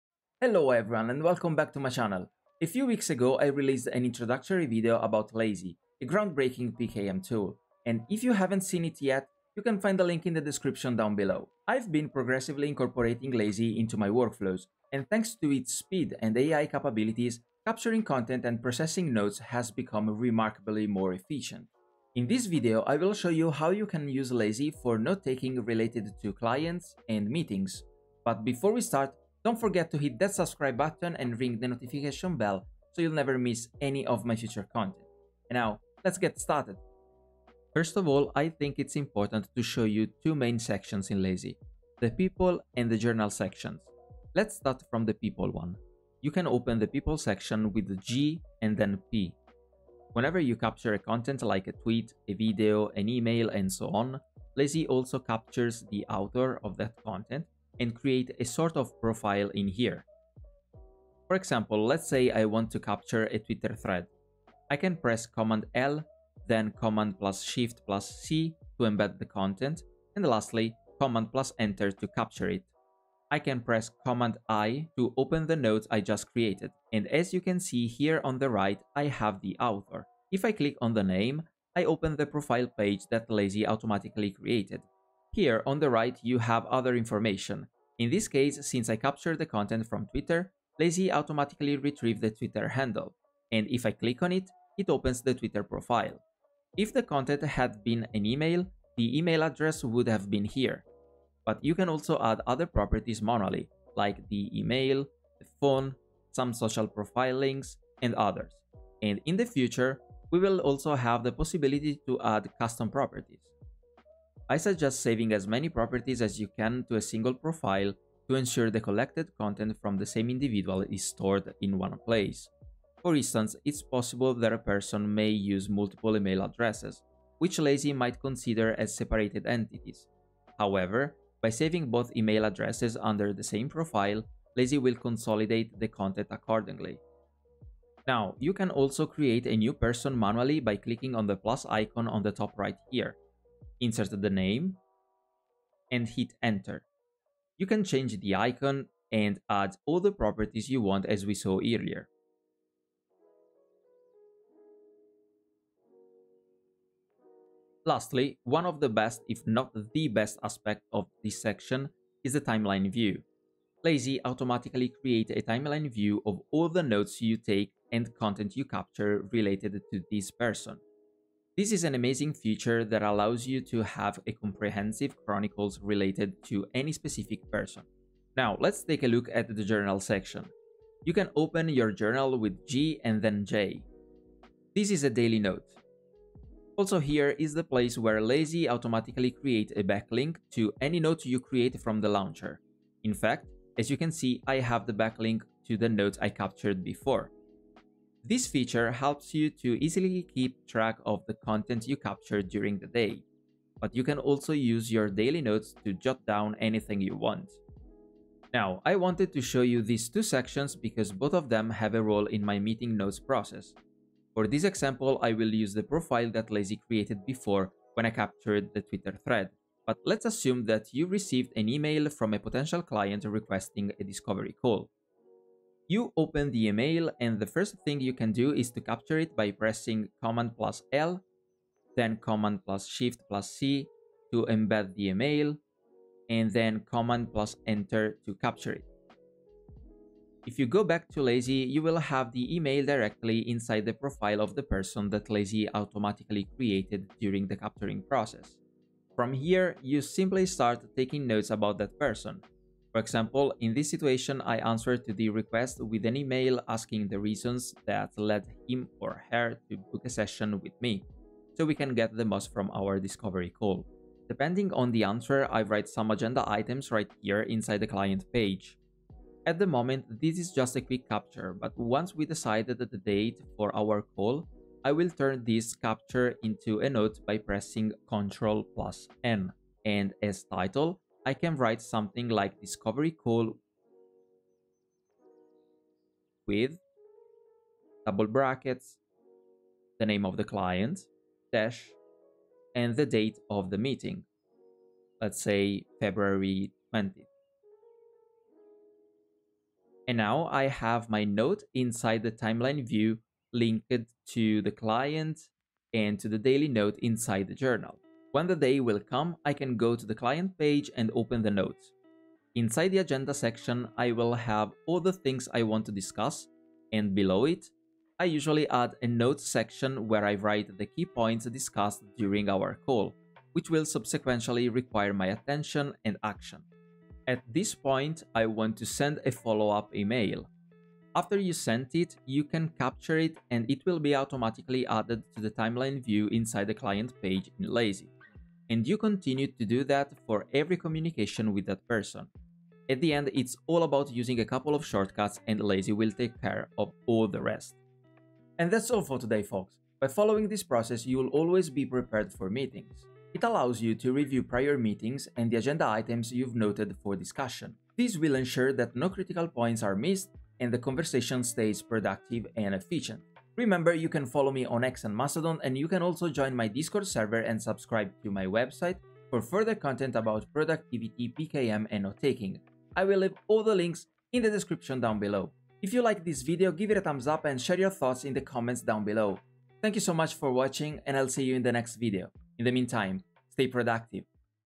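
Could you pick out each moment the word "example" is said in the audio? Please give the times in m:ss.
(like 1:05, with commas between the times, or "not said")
1:01, 3:34, 4:12.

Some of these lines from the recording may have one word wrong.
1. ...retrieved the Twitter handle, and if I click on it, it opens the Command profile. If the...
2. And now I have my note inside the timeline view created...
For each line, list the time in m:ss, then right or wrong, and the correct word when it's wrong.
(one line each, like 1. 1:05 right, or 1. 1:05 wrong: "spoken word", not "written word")
1. 1:31 wrong: "Twitter", not "Command"
2. 5:00 wrong: "linked", not "created".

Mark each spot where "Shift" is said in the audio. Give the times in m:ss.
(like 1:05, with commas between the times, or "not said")
1:07, 3:52.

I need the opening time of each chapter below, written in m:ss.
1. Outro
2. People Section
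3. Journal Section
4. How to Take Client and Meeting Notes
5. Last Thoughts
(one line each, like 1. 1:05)
1. 6:04
2. 0:46
3. 3:00
4. 3:35
5. 5:48.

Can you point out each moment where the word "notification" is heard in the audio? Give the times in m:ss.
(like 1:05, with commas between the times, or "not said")
0:31.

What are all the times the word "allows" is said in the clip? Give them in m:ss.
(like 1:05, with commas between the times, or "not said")
2:53, 5:53.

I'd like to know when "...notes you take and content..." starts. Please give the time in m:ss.
2:46.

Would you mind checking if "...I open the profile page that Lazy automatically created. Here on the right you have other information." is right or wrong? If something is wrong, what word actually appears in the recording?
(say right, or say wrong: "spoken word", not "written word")
right.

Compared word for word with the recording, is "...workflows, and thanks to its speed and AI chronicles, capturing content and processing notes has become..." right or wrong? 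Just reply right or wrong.
wrong.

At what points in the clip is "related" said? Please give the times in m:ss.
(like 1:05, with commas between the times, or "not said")
0:25, 2:49, 2:55.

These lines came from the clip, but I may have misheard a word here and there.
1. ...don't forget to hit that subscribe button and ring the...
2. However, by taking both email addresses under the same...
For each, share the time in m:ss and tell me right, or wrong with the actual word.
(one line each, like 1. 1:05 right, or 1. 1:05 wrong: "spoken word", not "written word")
1. 0:29 right
2. 2:10 wrong: "saving", not "taking".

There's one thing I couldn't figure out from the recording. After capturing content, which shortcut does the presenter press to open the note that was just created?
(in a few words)
Command I.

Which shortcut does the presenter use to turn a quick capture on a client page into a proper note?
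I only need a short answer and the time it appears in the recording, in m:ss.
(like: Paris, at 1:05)
Ctrl plus N, at 4:38.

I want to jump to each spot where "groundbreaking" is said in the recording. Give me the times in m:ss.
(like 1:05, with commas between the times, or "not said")
0:06.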